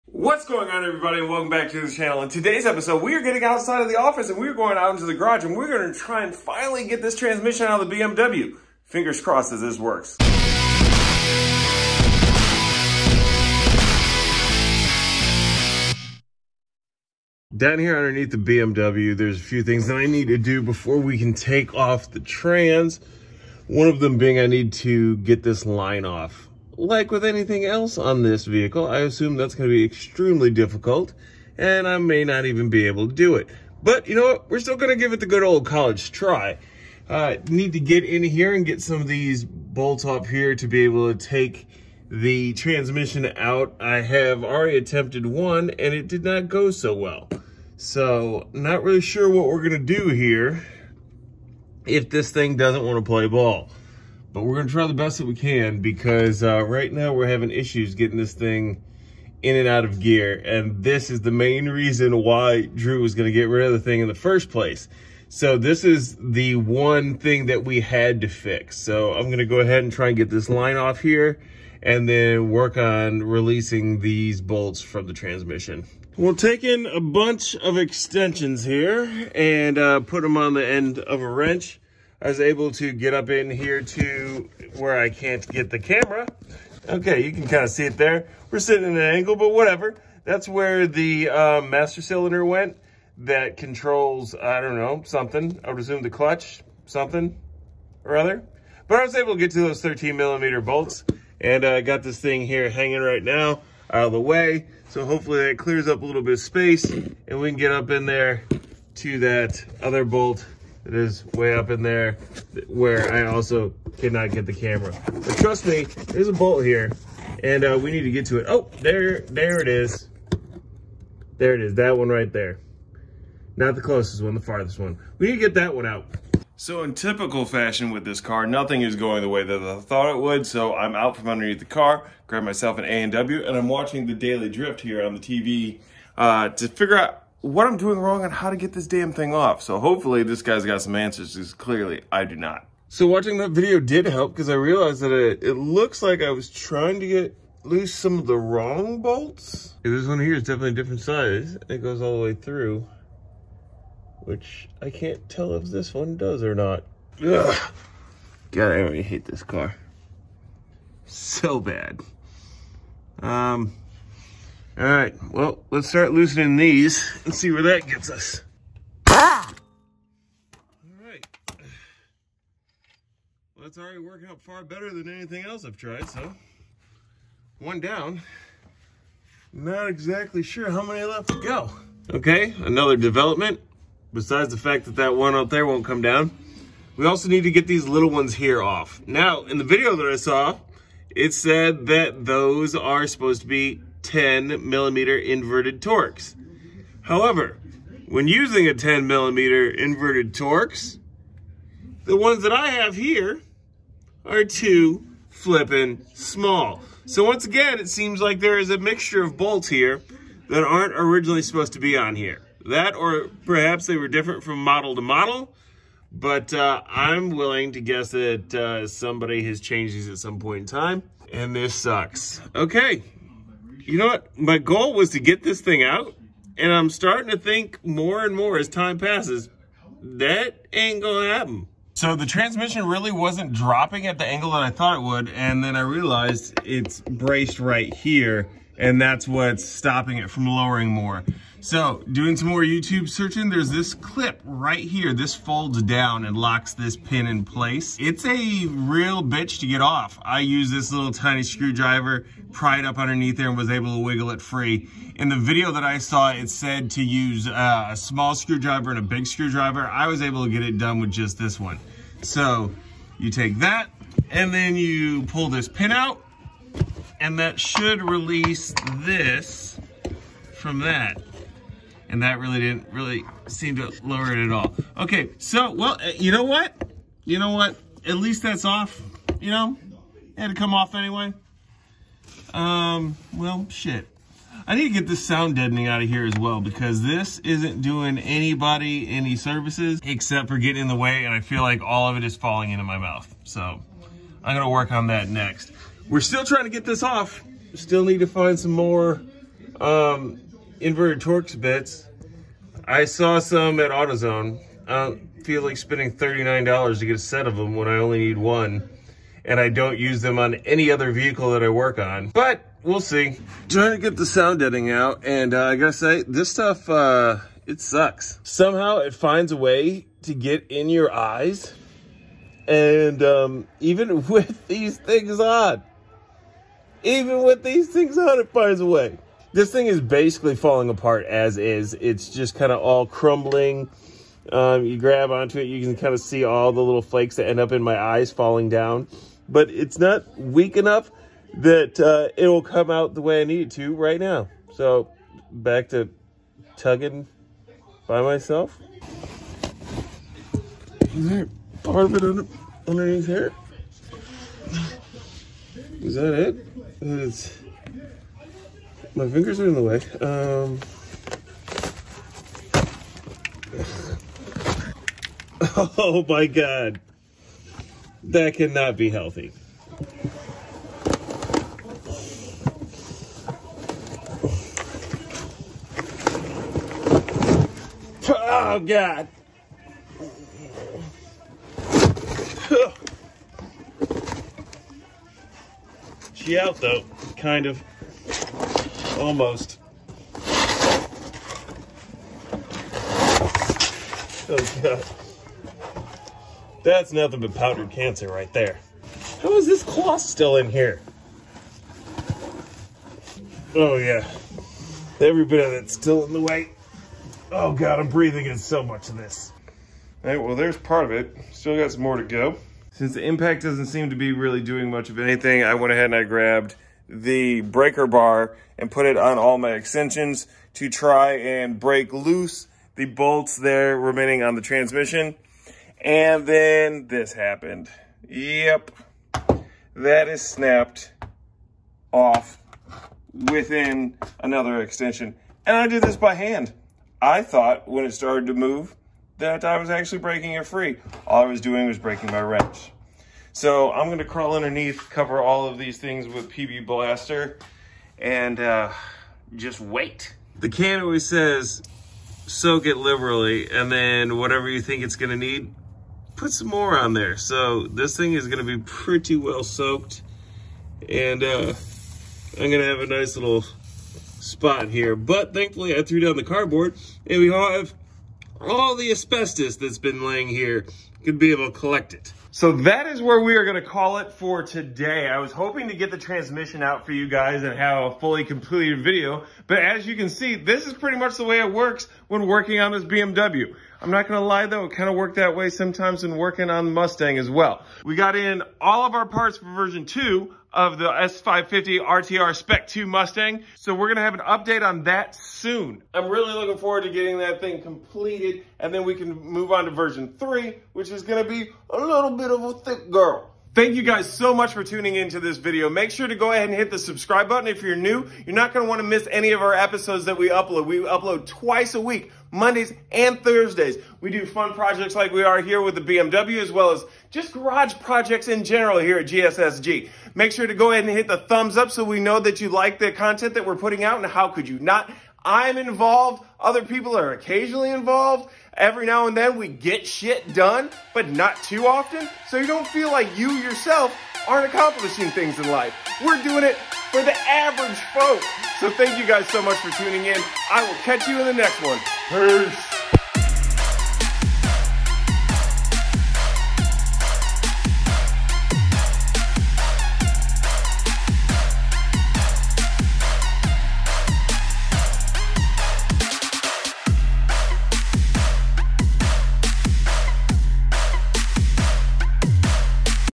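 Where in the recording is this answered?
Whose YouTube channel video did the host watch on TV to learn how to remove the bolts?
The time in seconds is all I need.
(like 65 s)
134 s.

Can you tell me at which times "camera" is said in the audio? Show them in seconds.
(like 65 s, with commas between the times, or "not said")
85 s, 114 s.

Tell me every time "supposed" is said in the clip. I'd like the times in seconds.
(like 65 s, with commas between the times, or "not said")
193 s, 211 s.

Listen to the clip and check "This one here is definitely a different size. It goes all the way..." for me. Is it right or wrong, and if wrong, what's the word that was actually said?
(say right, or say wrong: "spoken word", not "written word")
right.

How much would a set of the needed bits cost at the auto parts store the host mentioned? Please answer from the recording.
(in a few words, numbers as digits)
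$39.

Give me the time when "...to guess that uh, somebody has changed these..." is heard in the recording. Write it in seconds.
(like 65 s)
217 s.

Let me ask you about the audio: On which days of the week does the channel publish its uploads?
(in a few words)
Mondays and Thursdays.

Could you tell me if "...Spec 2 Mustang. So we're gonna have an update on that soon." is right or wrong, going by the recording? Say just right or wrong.
right.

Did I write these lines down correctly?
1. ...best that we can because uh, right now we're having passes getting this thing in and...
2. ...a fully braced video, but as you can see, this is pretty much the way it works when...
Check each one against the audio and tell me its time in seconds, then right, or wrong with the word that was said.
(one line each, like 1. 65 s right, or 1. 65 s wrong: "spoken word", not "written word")
1. 54 s wrong: "issues", not "passes"
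2. 478 s wrong: "completed", not "braced".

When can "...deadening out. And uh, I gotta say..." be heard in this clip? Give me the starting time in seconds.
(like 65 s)
314 s.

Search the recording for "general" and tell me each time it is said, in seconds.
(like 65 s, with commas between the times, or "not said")
518 s.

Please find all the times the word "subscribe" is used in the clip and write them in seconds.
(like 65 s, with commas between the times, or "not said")
506 s.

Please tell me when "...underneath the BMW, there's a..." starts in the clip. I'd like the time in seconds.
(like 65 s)
17 s.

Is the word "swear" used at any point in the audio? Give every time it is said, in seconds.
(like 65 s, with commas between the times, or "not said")
not said.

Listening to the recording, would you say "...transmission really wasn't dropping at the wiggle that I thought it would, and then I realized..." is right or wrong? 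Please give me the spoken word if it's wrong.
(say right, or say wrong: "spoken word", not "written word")
wrong: "angle", not "wiggle".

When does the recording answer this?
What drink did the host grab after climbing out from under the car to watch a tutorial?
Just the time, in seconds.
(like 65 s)
132 s.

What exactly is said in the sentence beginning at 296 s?
We're still trying to get this off.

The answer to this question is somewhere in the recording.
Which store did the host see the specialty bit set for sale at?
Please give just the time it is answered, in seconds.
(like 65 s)
303 s.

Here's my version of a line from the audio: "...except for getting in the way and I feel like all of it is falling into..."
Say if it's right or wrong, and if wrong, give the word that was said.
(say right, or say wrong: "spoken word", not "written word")
right.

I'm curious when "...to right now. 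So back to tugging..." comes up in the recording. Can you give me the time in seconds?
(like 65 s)
343 s.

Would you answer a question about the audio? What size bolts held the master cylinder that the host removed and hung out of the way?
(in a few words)
13 millimeter.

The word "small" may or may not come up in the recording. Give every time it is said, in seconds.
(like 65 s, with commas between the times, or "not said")
206 s, 257 s.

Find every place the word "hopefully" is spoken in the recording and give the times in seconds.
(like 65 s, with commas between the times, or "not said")
105 s, 139 s.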